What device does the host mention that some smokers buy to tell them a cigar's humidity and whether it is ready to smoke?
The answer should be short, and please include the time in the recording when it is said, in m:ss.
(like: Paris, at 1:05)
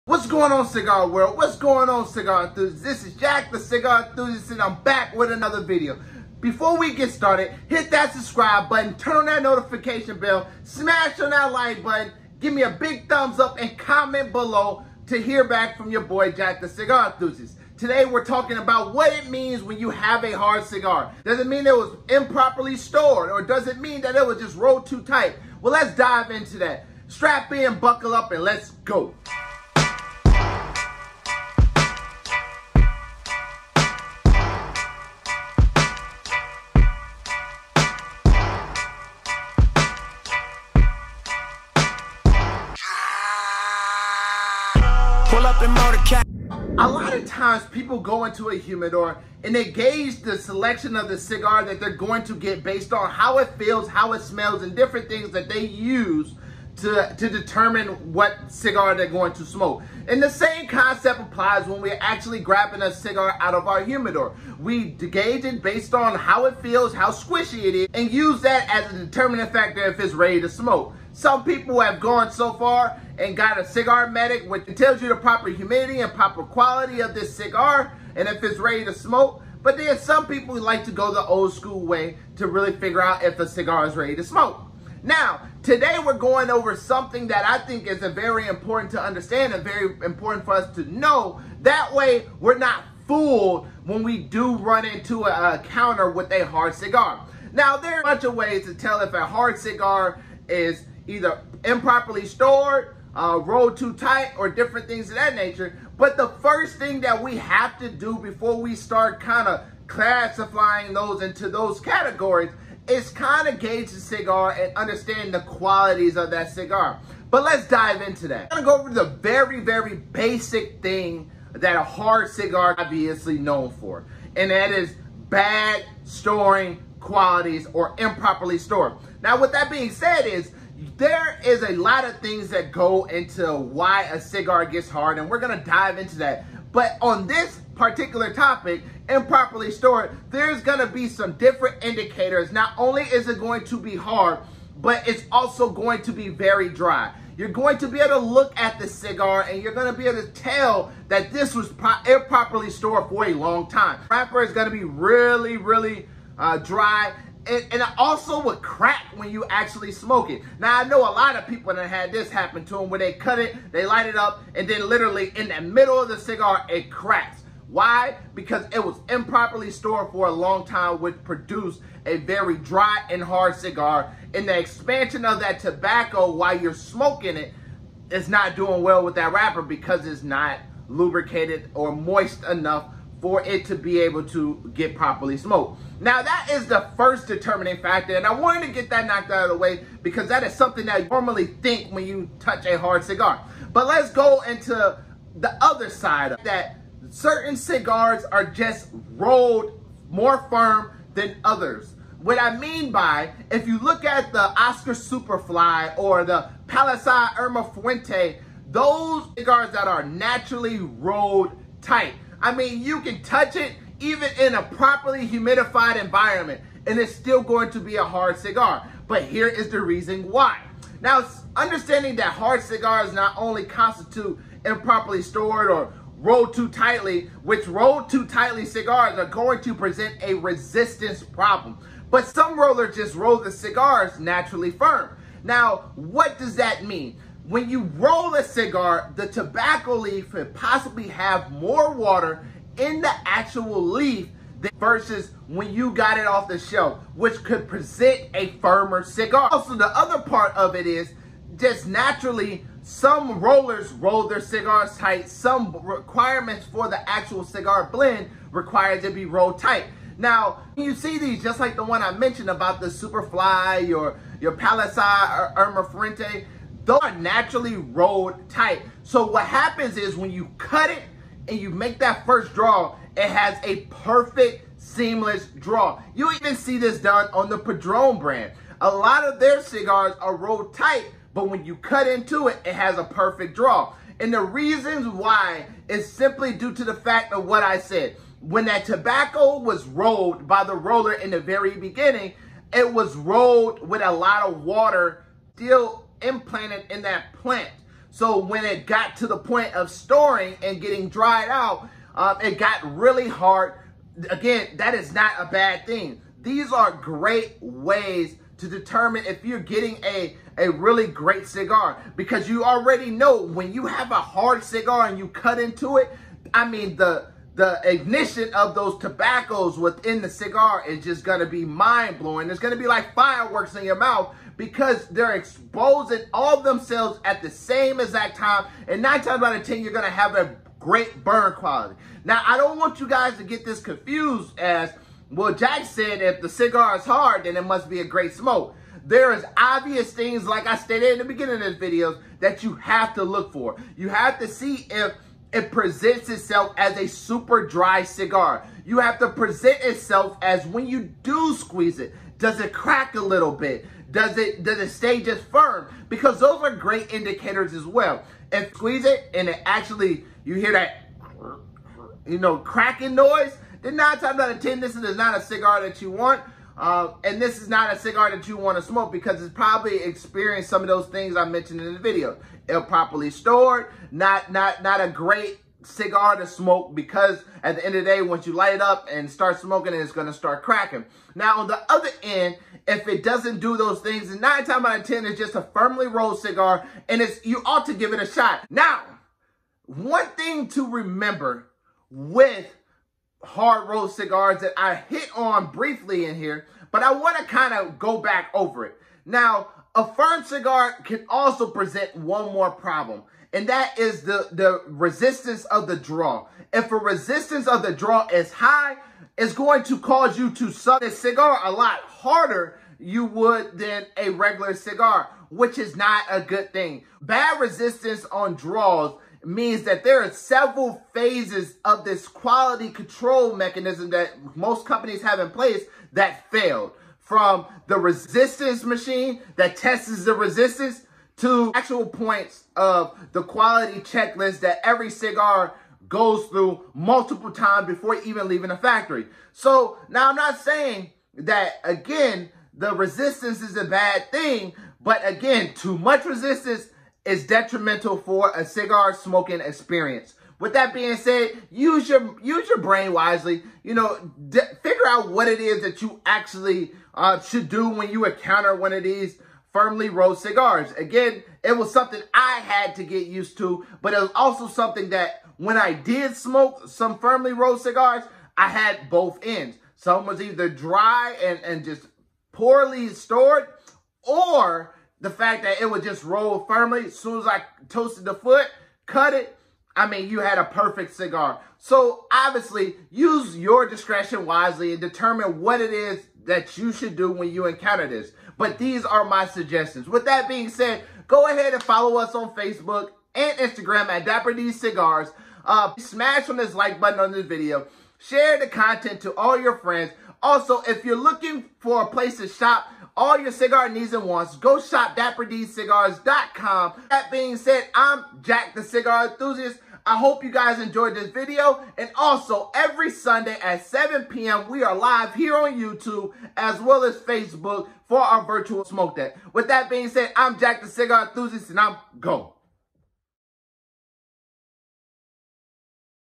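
cigar medic, at 1:13.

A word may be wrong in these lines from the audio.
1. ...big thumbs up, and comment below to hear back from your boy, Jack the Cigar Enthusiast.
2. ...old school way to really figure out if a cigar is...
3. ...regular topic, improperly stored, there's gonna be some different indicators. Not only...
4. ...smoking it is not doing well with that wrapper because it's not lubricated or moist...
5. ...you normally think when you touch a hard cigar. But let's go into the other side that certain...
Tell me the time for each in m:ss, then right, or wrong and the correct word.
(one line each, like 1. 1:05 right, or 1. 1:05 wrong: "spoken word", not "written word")
1. 0:12 right
2. 1:21 right
3. 2:17 wrong: "particular", not "regular"
4. 2:56 right
5. 3:11 right.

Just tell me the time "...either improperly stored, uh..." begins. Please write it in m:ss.
1:41.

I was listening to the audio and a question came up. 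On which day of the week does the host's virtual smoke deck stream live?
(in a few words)
Sunday.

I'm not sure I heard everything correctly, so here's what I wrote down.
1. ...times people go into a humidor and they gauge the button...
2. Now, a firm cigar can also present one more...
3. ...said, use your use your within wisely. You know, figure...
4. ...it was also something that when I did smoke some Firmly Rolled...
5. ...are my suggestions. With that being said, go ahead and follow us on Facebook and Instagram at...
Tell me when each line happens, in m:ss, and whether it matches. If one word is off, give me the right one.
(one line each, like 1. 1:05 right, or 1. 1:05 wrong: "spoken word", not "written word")
1. 0:47 wrong: "selection", not "button"
2. 6:39 right
3. 7:31 wrong: "brain", not "within"
4. 7:44 right
5. 8:09 right.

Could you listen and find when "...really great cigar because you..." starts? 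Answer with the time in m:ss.
5:10.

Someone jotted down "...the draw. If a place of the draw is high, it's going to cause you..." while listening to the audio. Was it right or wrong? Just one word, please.
wrong.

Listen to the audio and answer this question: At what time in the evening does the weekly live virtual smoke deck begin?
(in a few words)
7 p.m.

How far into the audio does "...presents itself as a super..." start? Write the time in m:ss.
5:45.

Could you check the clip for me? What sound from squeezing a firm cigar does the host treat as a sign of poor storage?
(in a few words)
cracking noise.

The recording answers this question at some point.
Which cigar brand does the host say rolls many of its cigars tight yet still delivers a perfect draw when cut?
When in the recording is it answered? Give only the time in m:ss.
4:37.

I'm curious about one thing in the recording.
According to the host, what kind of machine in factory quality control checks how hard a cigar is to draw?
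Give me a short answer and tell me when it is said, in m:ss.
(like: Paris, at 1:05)
resistance machine, at 7:07.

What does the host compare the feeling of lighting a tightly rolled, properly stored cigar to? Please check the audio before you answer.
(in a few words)
fireworks.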